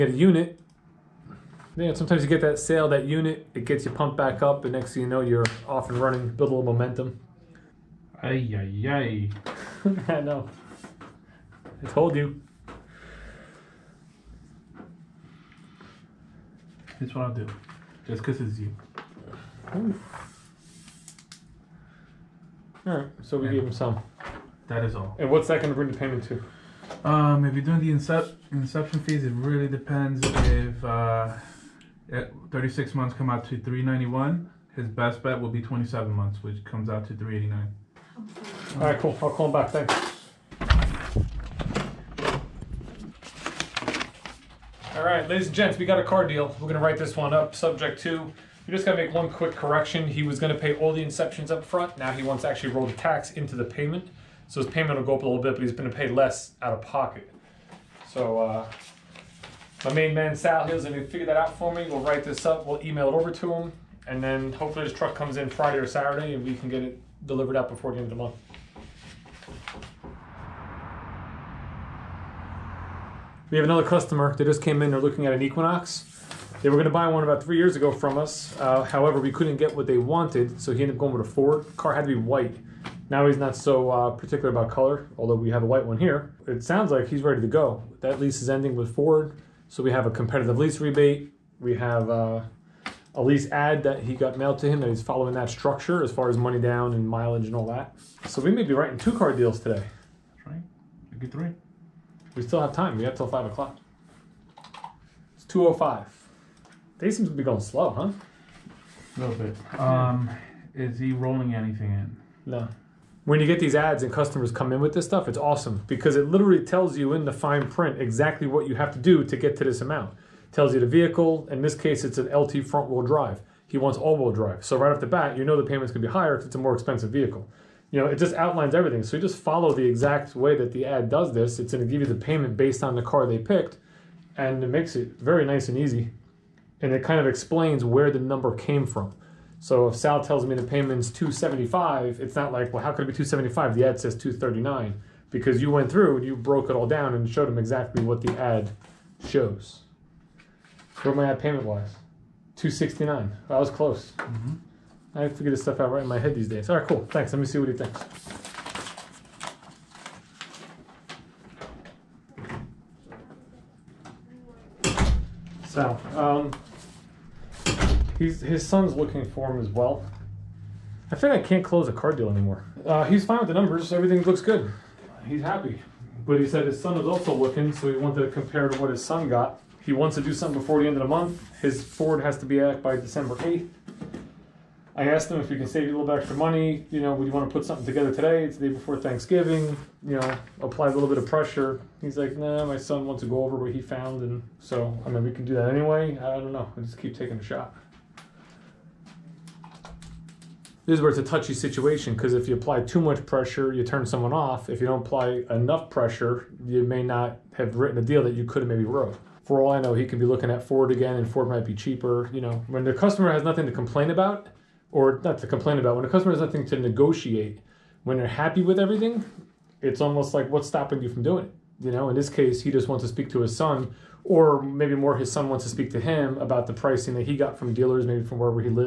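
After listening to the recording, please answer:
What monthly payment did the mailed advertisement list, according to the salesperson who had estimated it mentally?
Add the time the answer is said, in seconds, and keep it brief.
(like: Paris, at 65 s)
269, at 152 s.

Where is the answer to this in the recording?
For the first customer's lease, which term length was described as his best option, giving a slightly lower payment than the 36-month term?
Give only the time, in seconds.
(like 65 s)
35 s.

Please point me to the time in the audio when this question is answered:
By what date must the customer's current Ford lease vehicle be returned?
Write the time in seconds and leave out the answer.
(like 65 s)
182 s.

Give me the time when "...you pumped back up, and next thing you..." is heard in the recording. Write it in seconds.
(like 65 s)
3 s.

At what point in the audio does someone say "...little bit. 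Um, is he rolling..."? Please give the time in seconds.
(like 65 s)
109 s.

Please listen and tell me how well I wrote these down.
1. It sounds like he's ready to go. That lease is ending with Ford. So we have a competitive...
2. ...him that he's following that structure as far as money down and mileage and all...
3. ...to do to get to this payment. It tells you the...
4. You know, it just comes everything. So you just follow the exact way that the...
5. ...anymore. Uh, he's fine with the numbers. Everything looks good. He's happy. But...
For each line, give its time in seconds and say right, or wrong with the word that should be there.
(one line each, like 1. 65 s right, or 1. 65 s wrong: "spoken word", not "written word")
1. 86 s right
2. 94 s right
3. 118 s wrong: "amount", not "payment"
4. 127 s wrong: "outlines", not "comes"
5. 172 s right.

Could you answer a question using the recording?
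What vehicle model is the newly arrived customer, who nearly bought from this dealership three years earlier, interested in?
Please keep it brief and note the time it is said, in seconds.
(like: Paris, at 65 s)
Equinox, at 75 s.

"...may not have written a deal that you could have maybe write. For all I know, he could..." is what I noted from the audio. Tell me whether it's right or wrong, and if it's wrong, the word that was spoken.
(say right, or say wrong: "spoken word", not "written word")
wrong: "wrote", not "write".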